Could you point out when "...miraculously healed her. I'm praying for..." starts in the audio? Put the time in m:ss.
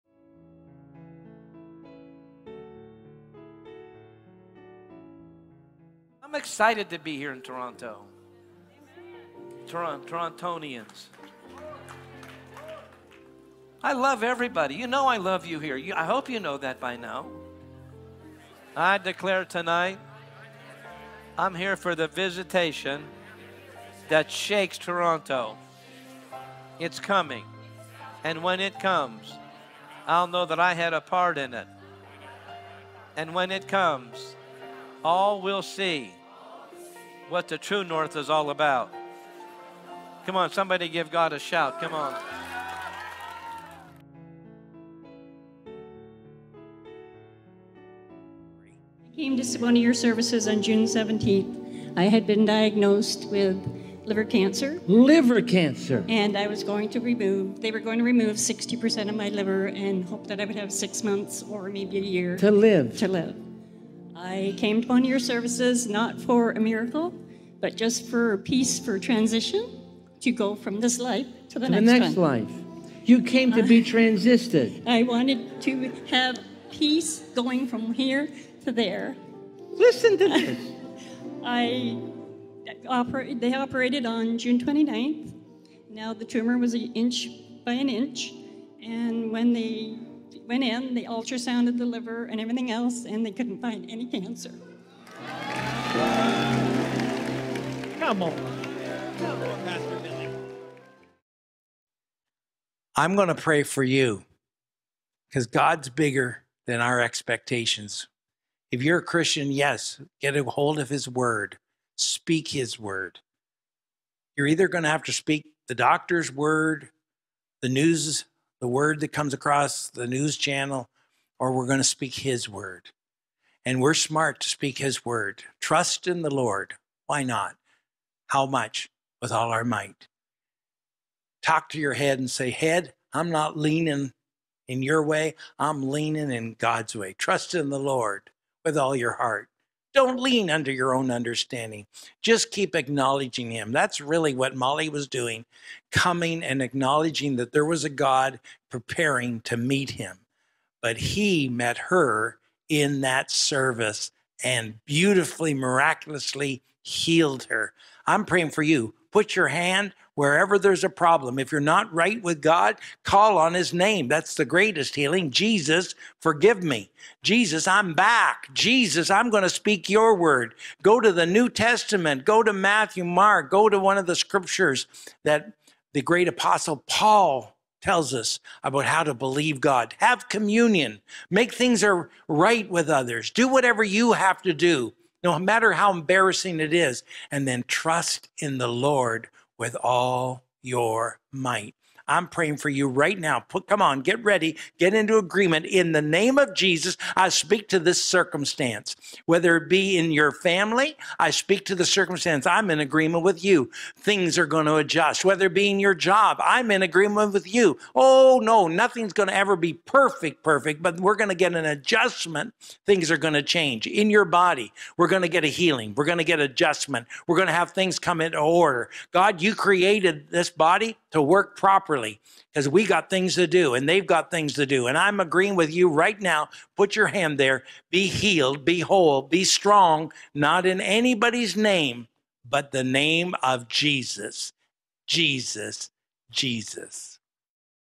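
2:35.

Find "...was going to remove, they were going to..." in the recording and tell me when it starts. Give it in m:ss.
0:56.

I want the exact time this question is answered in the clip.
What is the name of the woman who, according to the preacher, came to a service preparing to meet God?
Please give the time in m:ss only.
2:24.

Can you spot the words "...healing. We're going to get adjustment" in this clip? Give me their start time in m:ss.
3:35.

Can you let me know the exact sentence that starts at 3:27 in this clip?
Oh, no, nothing's going to ever be perfect, perfect, but we're going to get an adjustment.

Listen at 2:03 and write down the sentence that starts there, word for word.
And we're smart to speak His word.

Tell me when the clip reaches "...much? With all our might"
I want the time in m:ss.
2:08.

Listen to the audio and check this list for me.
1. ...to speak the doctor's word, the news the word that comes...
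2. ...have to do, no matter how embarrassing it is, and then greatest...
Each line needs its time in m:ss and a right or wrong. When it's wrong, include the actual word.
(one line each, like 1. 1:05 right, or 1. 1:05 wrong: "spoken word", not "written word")
1. 1:55 right
2. 3:04 wrong: "trust", not "greatest".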